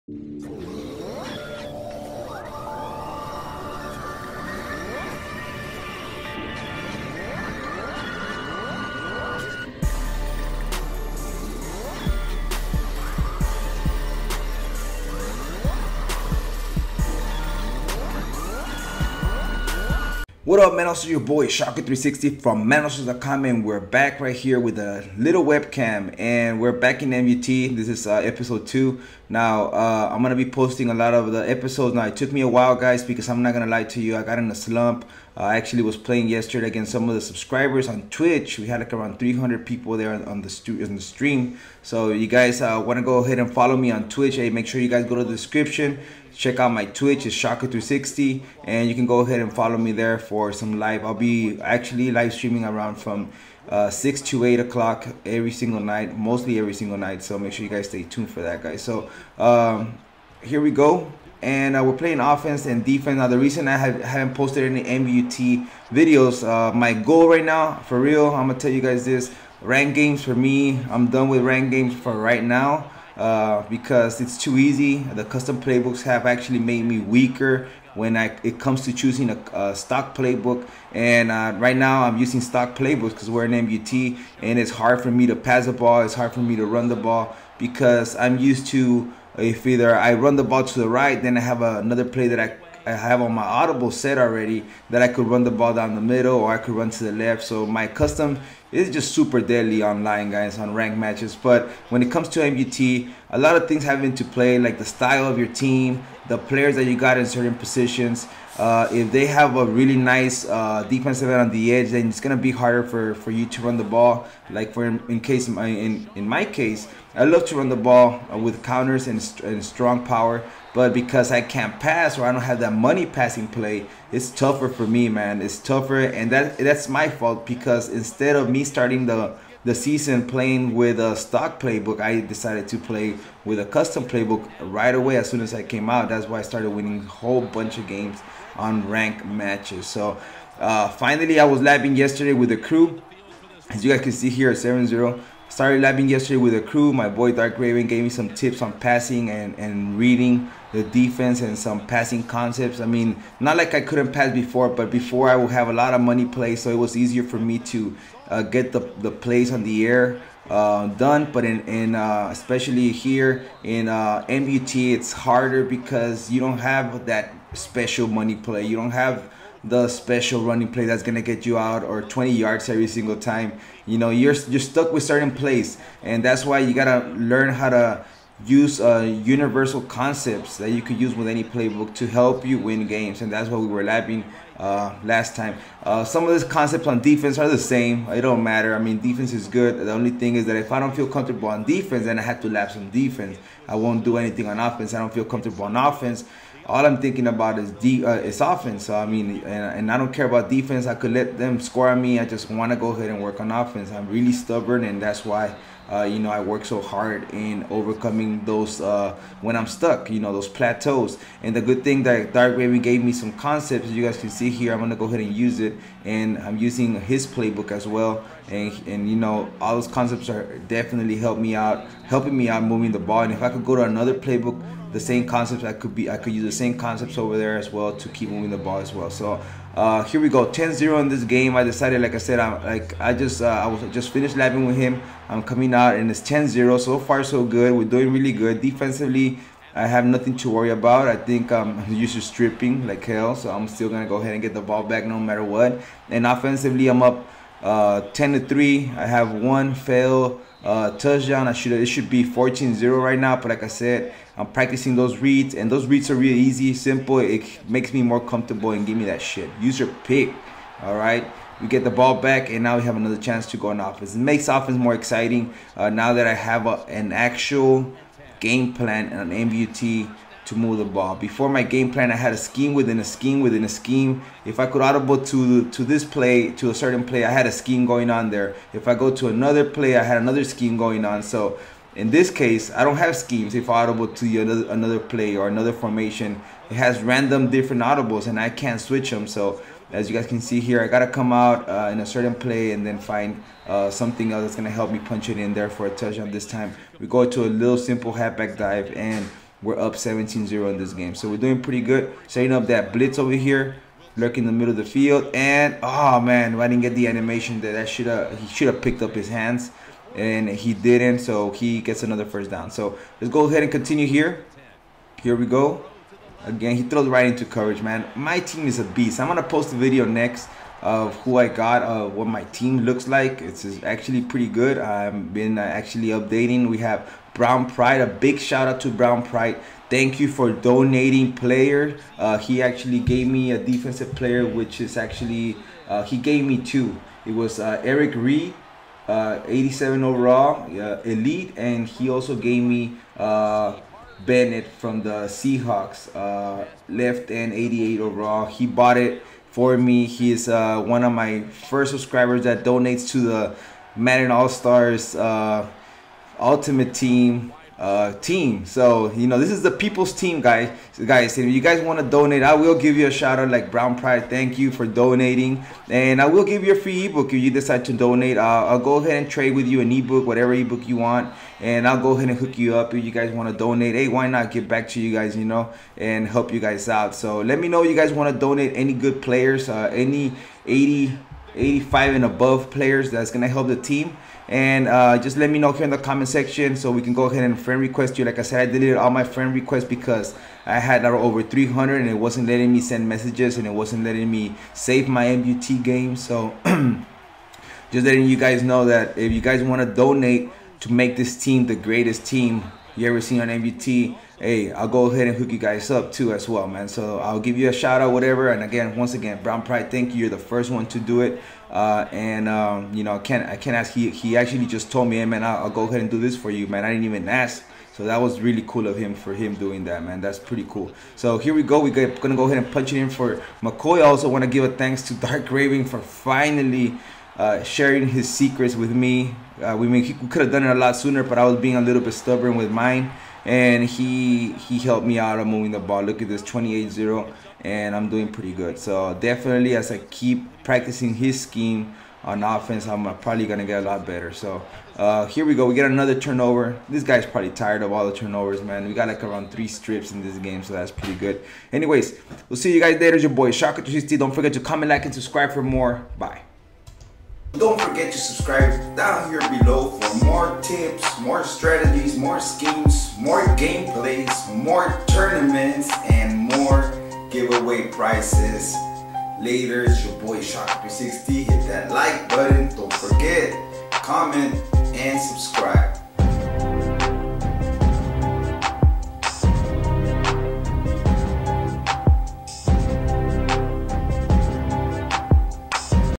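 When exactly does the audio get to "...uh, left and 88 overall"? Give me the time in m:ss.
5:46.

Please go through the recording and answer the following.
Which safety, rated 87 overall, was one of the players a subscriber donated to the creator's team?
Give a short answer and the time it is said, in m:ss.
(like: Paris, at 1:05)
Eric Reid, at 5:37.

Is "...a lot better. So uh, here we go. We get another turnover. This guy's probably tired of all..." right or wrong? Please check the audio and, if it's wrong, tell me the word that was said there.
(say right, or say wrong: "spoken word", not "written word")
right.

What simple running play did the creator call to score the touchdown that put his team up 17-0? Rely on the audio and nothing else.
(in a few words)
halfback dive.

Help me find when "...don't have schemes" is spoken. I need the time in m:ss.
4:42.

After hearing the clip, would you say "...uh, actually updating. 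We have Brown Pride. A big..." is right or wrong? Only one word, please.
right.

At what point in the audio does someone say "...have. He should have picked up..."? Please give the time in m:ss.
5:08.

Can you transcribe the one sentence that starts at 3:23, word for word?
I'm really stubborn, and that's why.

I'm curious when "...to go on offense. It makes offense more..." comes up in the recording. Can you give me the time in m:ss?
4:23.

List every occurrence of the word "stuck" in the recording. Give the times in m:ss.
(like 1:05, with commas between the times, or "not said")
2:54, 3:29.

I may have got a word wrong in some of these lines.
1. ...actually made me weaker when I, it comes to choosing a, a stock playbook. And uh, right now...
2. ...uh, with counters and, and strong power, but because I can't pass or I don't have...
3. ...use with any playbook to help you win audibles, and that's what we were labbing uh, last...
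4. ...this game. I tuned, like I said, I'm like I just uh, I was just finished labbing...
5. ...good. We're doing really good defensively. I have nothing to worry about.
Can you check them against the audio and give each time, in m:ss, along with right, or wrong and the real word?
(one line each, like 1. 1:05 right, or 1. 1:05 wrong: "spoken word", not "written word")
1. 1:16 right
2. 1:58 right
3. 3:00 wrong: "games", not "audibles"
4. 3:51 wrong: "decided", not "tuned"
5. 3:57 right.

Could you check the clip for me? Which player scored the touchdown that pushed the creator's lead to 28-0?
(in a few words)
McCoy.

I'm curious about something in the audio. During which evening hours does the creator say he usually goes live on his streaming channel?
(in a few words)
6 to 8 o'clock.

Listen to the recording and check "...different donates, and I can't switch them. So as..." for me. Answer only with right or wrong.
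wrong.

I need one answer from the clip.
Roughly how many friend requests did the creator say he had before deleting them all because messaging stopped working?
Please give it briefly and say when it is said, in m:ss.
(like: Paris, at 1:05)
over 300, at 6:31.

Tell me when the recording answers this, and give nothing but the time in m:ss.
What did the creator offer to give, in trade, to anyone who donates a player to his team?
6:06.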